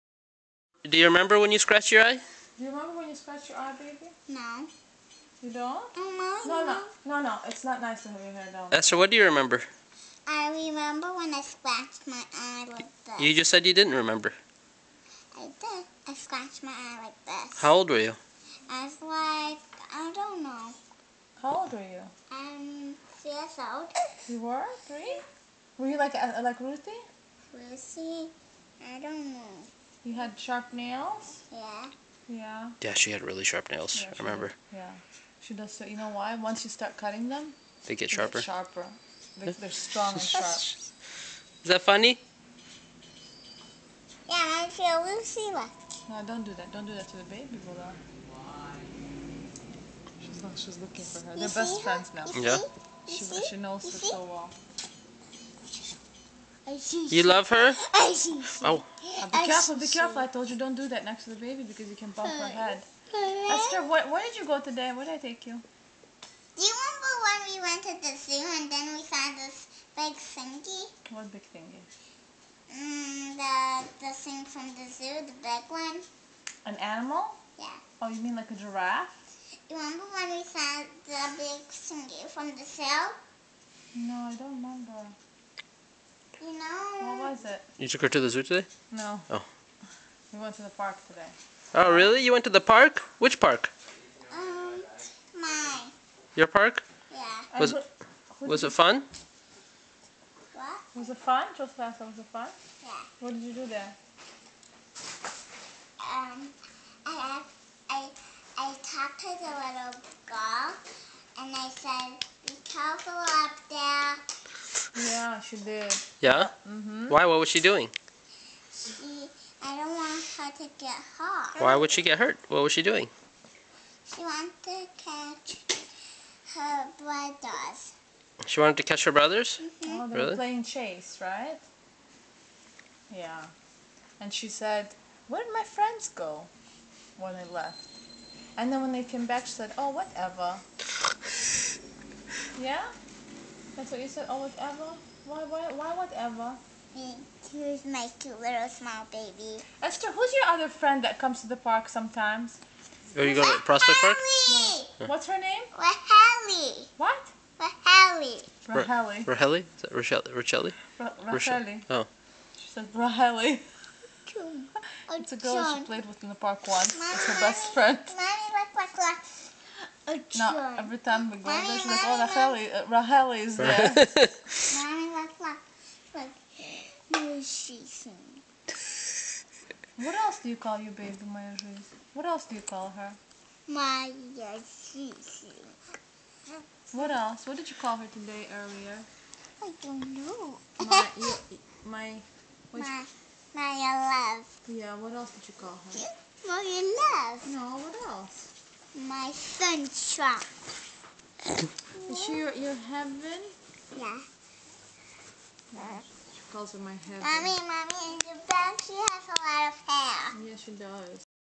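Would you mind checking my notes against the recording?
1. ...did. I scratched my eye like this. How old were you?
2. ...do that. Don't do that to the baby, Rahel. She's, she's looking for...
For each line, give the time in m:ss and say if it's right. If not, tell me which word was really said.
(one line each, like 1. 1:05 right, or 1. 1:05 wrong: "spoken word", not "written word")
1. 0:15 right
2. 0:46 wrong: "Bola", not "Rahel".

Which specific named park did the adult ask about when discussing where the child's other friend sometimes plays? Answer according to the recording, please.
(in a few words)
Prospect Park.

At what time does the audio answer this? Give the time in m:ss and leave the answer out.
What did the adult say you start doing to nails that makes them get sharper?
0:36.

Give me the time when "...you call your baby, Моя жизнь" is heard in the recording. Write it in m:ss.
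3:00.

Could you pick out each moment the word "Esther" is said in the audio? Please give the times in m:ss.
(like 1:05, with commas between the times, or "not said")
0:08, 1:03, 2:29.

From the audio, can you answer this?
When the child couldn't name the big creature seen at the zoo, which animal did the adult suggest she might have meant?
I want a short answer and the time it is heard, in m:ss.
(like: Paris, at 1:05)
giraffe, at 1:18.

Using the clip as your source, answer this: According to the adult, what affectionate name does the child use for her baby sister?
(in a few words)
my heaven.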